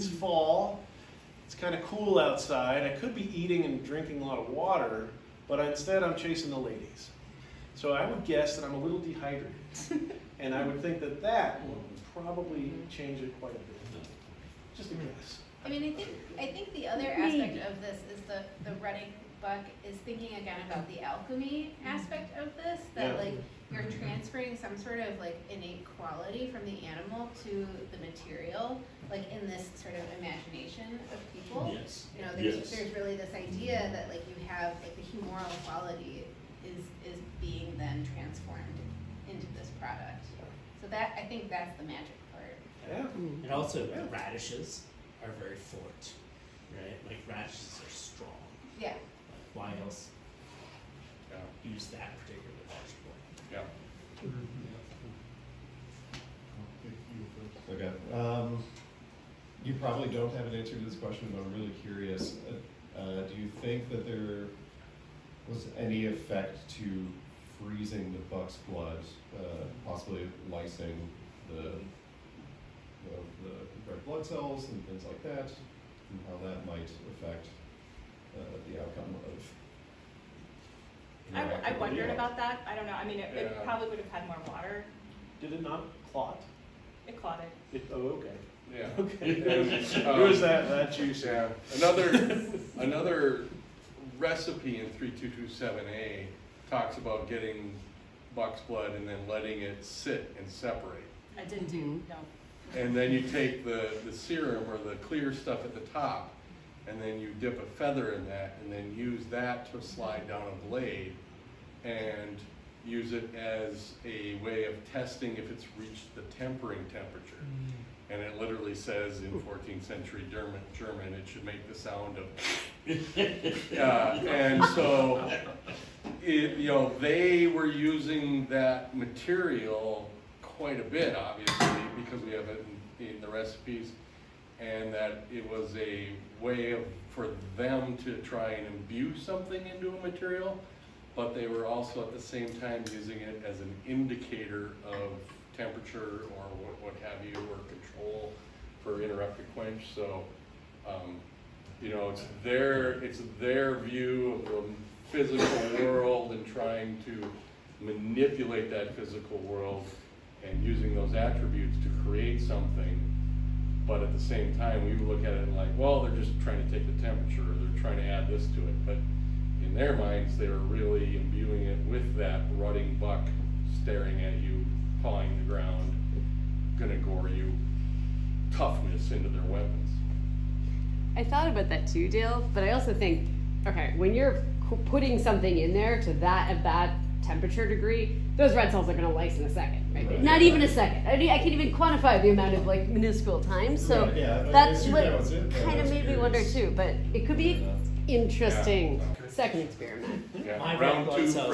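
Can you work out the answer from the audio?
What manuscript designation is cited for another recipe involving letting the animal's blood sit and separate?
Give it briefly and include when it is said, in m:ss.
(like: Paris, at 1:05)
3227A, at 1:34.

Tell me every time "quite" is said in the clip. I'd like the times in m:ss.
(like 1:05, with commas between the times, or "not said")
0:13, 2:10.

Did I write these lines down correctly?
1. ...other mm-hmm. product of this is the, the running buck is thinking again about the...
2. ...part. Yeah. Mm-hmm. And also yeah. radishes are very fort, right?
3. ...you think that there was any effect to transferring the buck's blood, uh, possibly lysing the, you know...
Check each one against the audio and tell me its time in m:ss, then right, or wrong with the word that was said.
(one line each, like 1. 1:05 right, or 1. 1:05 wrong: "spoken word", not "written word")
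1. 0:16 wrong: "aspect", not "product"
2. 0:42 right
3. 1:03 wrong: "freezing", not "transferring".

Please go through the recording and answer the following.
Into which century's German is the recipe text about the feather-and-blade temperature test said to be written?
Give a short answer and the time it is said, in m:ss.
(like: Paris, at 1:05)
14th century, at 1:59.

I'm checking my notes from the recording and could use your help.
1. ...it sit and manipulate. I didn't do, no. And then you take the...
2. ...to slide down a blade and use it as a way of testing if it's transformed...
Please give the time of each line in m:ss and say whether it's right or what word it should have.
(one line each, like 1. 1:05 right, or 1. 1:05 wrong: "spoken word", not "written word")
1. 1:39 wrong: "separate", not "manipulate"
2. 1:49 wrong: "reached", not "transformed".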